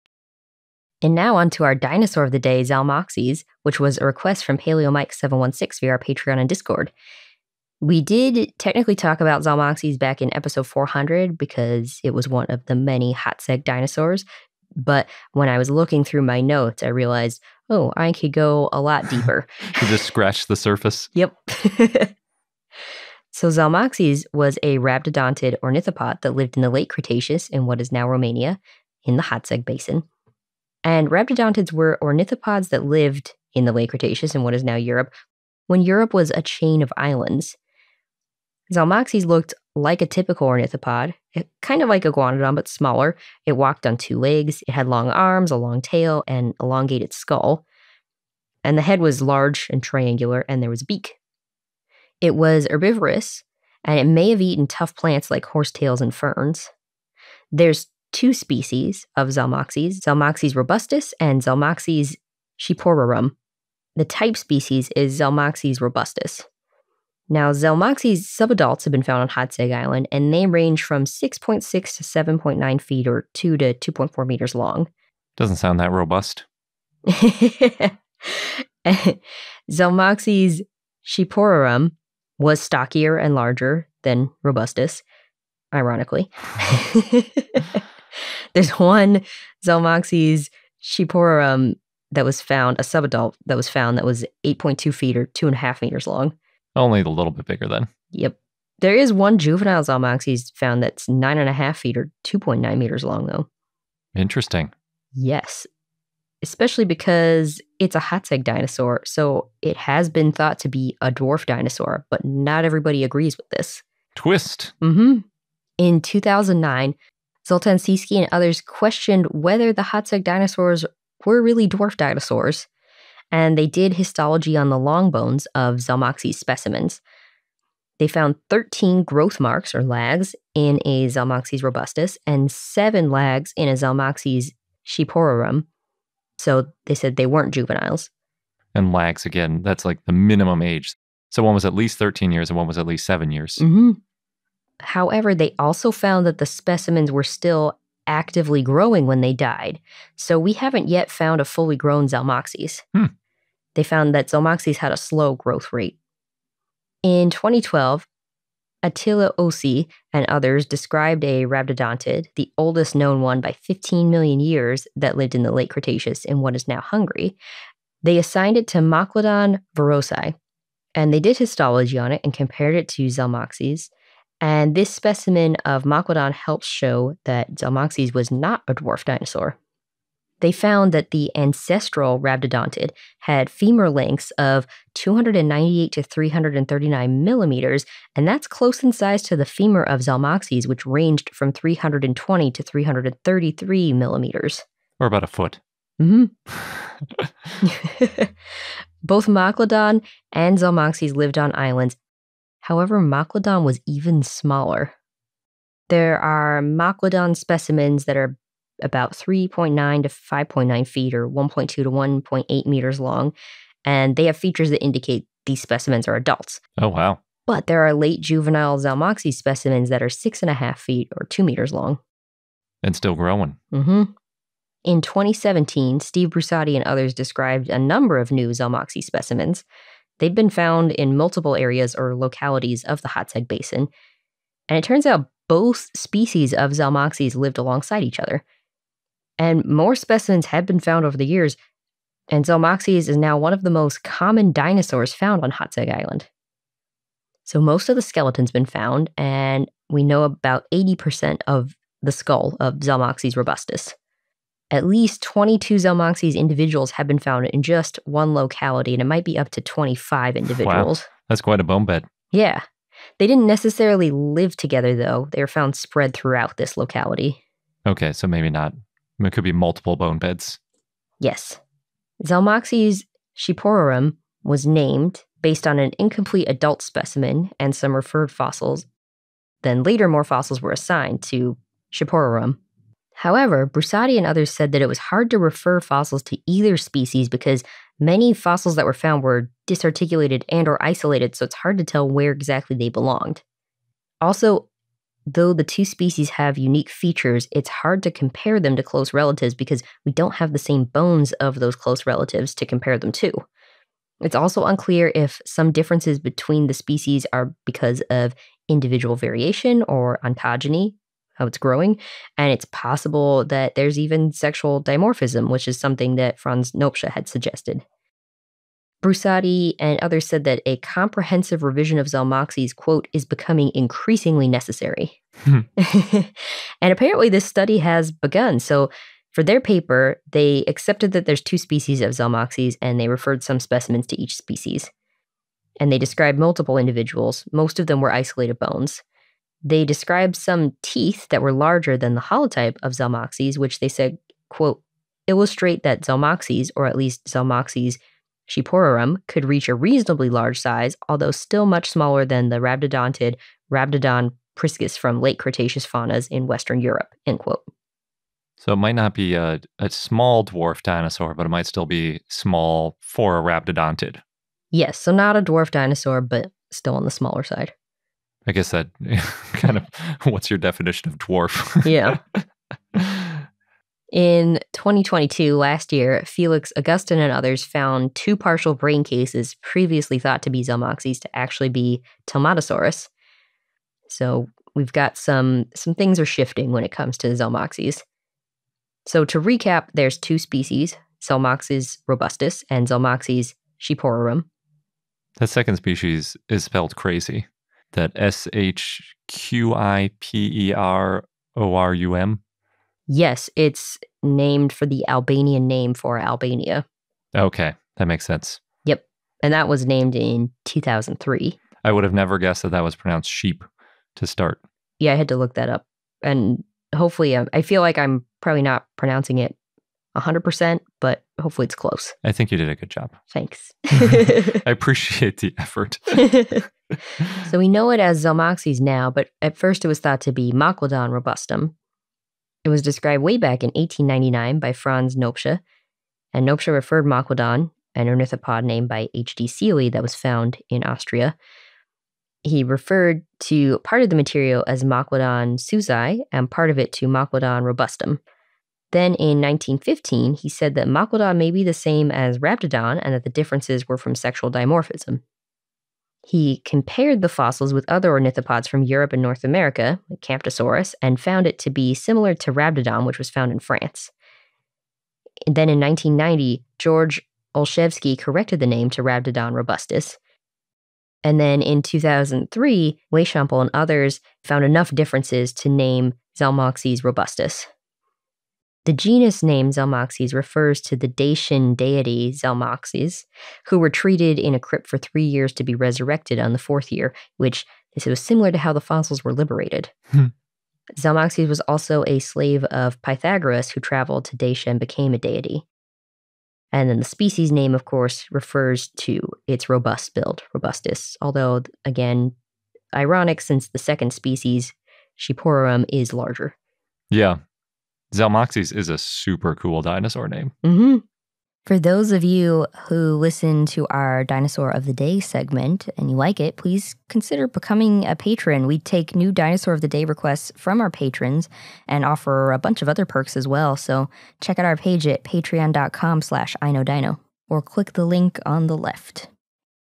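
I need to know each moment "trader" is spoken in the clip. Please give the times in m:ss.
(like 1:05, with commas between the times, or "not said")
not said.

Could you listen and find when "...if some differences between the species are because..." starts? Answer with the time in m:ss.
5:05.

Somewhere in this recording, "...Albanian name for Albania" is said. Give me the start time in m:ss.
6:45.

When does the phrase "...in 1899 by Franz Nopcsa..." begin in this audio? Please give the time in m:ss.
7:13.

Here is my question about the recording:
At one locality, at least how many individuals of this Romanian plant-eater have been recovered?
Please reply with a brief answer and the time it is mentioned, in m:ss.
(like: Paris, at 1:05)
22, at 4:15.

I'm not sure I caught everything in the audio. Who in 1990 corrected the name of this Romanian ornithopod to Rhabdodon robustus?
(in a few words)
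George Olshevsky.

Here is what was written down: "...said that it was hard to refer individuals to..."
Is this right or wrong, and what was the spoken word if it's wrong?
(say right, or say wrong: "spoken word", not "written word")
wrong: "fossils", not "individuals".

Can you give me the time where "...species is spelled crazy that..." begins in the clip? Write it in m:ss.
6:35.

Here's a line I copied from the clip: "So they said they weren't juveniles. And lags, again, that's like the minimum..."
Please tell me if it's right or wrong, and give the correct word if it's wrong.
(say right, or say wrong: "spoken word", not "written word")
right.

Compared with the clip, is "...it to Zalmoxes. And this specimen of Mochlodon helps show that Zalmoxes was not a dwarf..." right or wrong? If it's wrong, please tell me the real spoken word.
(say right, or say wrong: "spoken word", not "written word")
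right.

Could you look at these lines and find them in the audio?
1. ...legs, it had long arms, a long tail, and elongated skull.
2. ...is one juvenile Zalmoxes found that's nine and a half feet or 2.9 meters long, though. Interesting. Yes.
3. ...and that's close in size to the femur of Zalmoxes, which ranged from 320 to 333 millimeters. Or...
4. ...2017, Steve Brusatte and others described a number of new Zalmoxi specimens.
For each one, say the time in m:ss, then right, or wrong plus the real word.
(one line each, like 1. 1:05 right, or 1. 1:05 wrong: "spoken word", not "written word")
1. 0:44 right
2. 1:38 right
3. 3:08 right
4. 3:45 right.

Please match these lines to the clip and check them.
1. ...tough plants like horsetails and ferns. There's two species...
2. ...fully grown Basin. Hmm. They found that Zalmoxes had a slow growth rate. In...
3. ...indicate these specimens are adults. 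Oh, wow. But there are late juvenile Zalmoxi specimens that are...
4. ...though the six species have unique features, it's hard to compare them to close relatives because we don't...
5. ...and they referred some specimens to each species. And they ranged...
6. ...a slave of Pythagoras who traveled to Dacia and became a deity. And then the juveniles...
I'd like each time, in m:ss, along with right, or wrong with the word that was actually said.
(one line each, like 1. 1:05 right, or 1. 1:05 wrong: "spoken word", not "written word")
1. 0:54 right
2. 2:31 wrong: "Zalmoxes", not "Basin"
3. 3:34 right
4. 4:55 wrong: "two", not "six"
5. 5:32 wrong: "described", not "ranged"
6. 8:12 wrong: "species", not "juveniles".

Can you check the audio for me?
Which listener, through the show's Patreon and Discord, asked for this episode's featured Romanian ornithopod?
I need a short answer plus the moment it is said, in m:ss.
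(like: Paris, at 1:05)
paleomike 716, at 0:04.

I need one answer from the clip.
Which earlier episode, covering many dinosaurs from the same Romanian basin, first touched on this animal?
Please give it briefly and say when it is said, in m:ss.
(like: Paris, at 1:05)
400, at 0:10.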